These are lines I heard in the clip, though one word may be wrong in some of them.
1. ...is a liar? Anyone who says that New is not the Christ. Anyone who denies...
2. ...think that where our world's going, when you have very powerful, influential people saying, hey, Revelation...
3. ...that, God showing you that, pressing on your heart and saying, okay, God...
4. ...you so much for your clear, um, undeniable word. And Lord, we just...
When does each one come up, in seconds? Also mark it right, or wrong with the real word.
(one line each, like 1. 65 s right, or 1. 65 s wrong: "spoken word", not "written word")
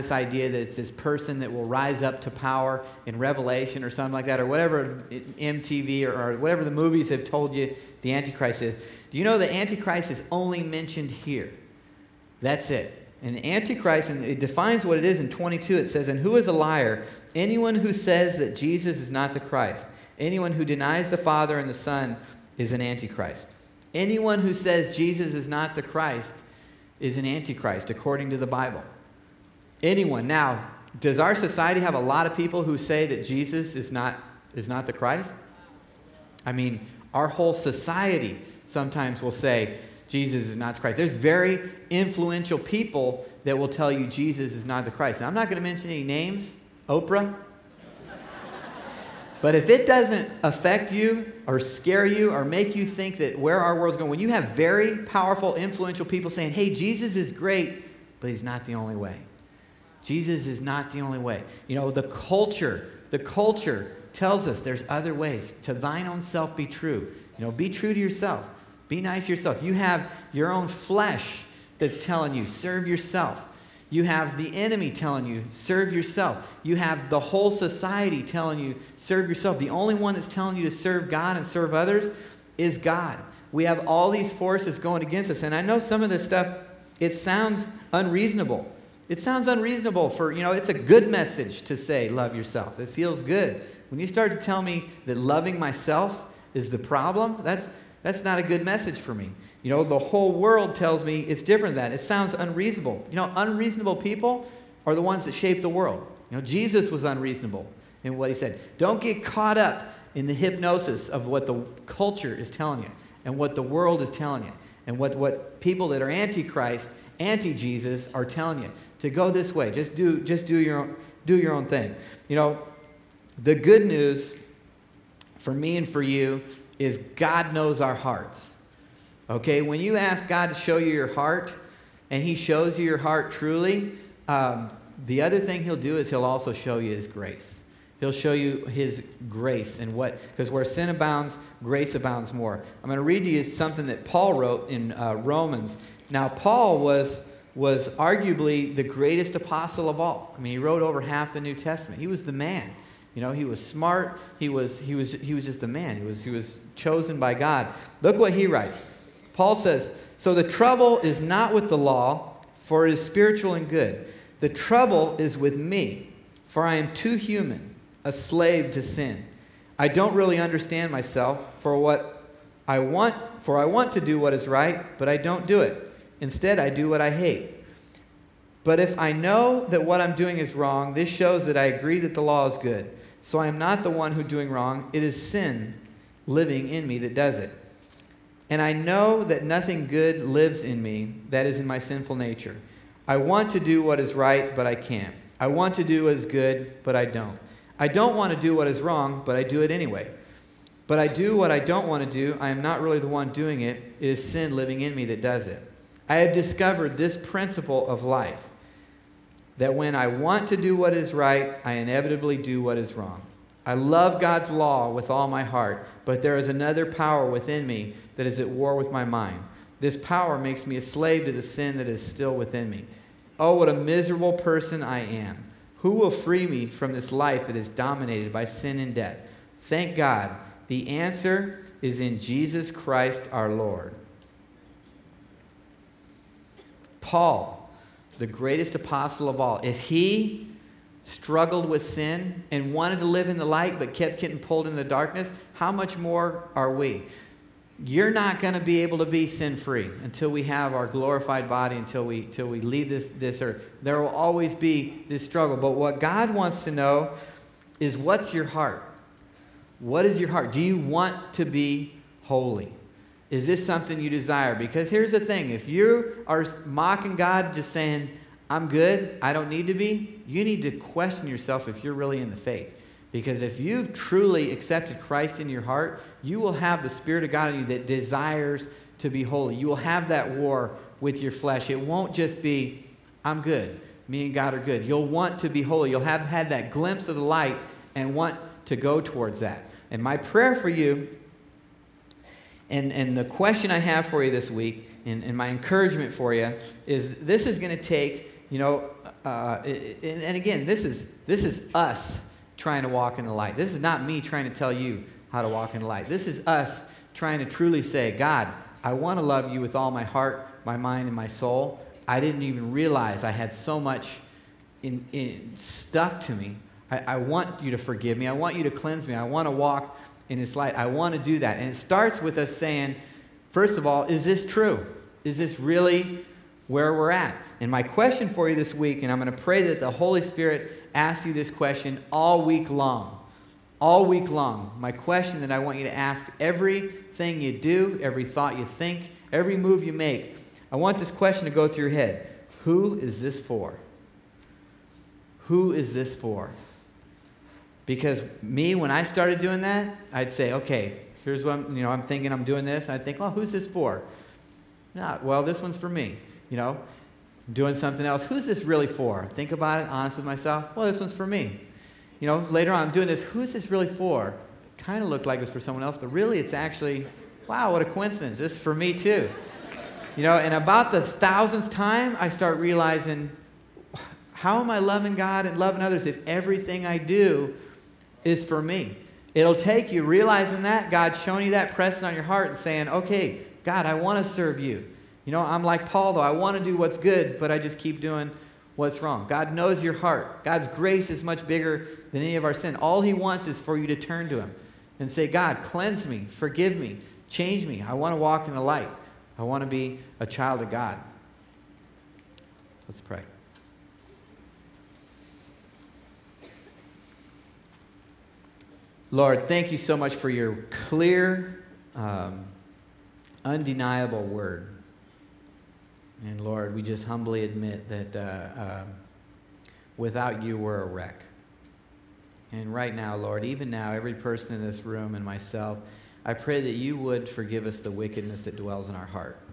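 1. 16 s wrong: "Jesus", not "New"
2. 52 s wrong: "Jesus", not "Revelation"
3. 380 s right
4. 409 s right.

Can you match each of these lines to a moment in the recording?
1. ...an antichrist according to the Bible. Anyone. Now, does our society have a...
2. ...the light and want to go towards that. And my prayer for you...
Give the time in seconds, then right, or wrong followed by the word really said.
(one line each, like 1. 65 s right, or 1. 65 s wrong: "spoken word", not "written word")
1. 27 s right
2. 287 s right.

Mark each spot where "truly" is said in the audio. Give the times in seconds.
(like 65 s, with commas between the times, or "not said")
133 s, 273 s, 307 s.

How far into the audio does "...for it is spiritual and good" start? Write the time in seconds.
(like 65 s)
162 s.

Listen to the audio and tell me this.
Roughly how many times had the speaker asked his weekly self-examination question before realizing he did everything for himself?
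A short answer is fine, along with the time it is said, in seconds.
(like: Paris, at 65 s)
The thousandth, at 371 s.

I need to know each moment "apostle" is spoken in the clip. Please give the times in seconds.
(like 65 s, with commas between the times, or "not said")
149 s, 238 s.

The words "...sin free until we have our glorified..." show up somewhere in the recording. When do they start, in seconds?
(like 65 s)
249 s.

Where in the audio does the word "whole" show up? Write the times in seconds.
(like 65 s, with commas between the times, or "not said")
37 s, 77 s, 99 s.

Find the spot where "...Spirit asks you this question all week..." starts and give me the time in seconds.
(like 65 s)
330 s.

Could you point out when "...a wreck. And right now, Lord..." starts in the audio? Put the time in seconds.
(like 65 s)
420 s.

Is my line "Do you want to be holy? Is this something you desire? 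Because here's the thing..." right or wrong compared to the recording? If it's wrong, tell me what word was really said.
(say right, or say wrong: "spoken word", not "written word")
right.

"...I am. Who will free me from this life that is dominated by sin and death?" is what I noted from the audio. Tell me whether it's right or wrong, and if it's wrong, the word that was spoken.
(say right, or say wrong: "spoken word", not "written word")
right.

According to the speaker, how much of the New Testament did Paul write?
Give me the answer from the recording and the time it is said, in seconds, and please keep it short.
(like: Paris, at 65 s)
Over half, at 150 s.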